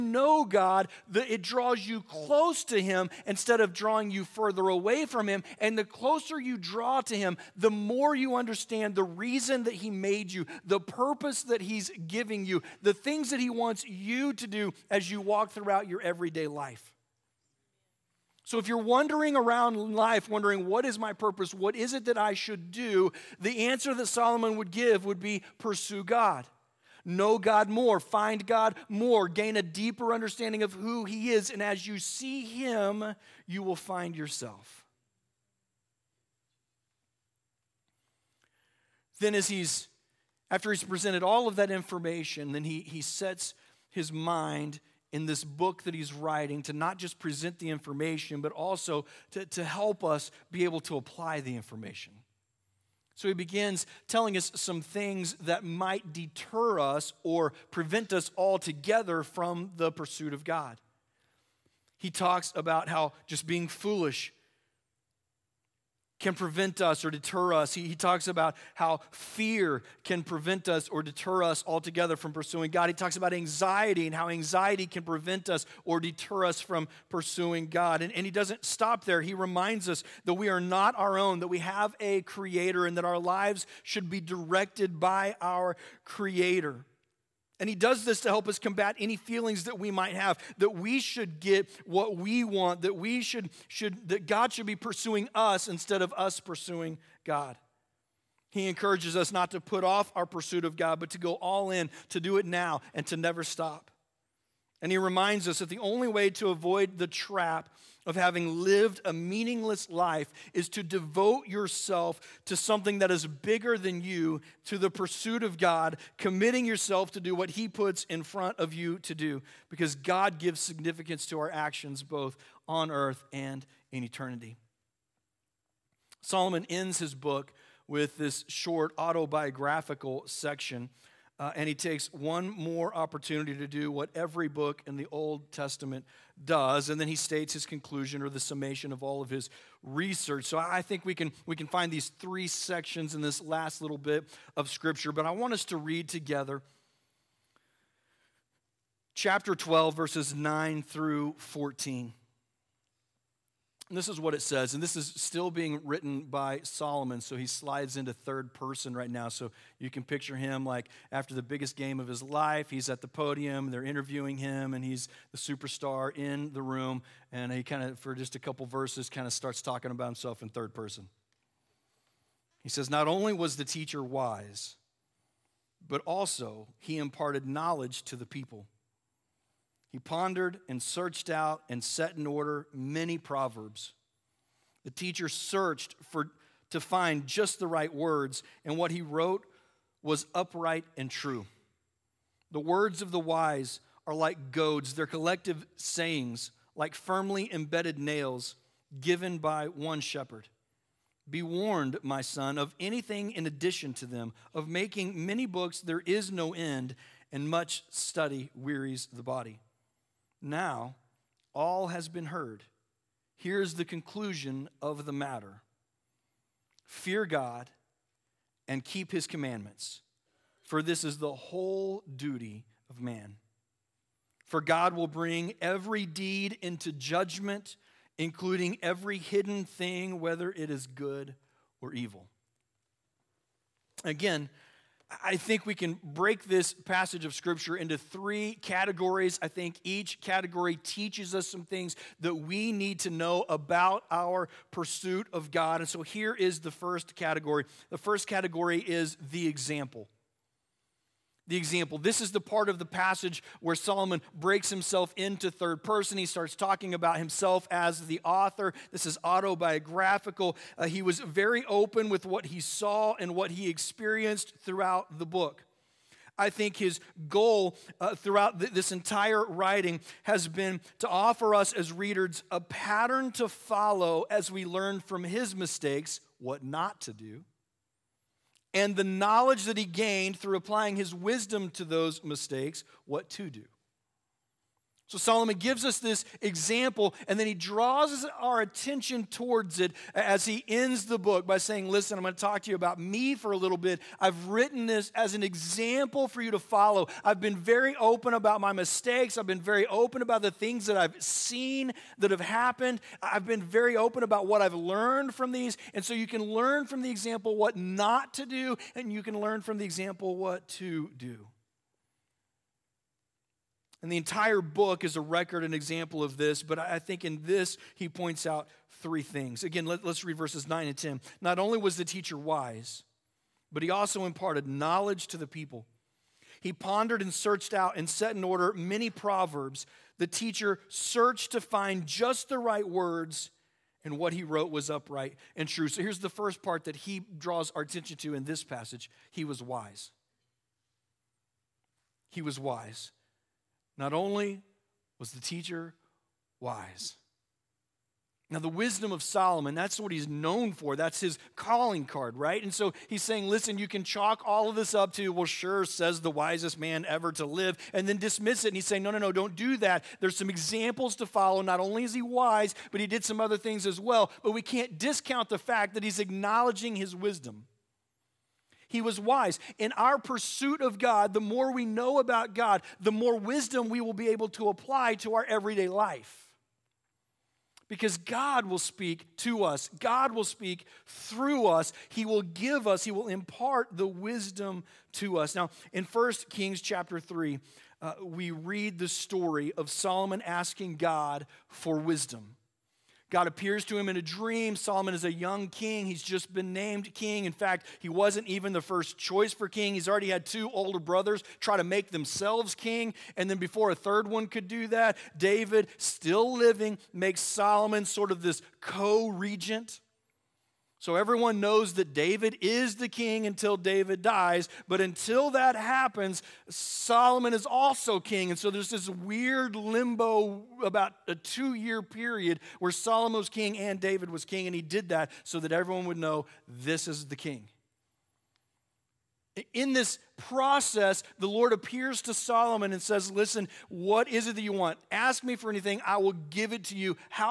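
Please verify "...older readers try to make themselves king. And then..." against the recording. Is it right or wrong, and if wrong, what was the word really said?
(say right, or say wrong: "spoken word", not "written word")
wrong: "brothers", not "readers".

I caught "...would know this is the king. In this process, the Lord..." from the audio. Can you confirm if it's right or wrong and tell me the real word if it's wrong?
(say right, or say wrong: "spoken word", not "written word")
right.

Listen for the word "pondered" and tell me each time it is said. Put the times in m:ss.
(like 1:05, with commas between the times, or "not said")
2:59, 5:26.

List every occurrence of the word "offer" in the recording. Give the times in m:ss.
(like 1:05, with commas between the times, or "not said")
4:31.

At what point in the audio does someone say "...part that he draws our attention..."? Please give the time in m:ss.
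5:36.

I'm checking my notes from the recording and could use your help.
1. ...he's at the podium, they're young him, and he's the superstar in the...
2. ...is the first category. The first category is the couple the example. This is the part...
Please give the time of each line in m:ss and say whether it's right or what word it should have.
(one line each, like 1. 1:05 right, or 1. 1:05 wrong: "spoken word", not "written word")
1. 2:42 wrong: "interviewing", not "young"
2. 4:06 wrong: "example", not "couple".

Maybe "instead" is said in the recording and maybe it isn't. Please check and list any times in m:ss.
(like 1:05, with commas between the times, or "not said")
0:03, 1:35.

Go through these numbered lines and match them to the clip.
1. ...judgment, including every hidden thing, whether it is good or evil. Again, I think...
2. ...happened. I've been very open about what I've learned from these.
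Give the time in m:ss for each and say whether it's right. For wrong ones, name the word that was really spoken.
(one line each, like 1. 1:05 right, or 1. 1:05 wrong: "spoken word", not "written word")
1. 3:46 right
2. 5:02 right.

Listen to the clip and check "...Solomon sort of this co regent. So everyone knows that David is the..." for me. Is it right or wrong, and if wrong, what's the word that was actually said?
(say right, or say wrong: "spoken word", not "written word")
right.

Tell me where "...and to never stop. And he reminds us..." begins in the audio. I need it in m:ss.
1:42.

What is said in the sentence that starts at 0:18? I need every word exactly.
So if you're wandering around life wondering, what is my purpose?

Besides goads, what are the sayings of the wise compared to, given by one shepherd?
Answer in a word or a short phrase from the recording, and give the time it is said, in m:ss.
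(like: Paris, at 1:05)
Firmly embedded nails, at 3:16.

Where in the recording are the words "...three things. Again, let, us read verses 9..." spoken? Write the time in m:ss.
5:19.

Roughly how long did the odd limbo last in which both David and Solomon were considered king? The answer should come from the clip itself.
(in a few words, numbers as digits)
About 2 years.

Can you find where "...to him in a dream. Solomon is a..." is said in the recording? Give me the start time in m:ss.
6:33.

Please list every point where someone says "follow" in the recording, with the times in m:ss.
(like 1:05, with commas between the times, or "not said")
4:33, 4:56, 6:01.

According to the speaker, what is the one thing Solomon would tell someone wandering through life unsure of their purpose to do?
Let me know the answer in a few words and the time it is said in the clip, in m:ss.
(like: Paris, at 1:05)
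Pursue God, at 0:25.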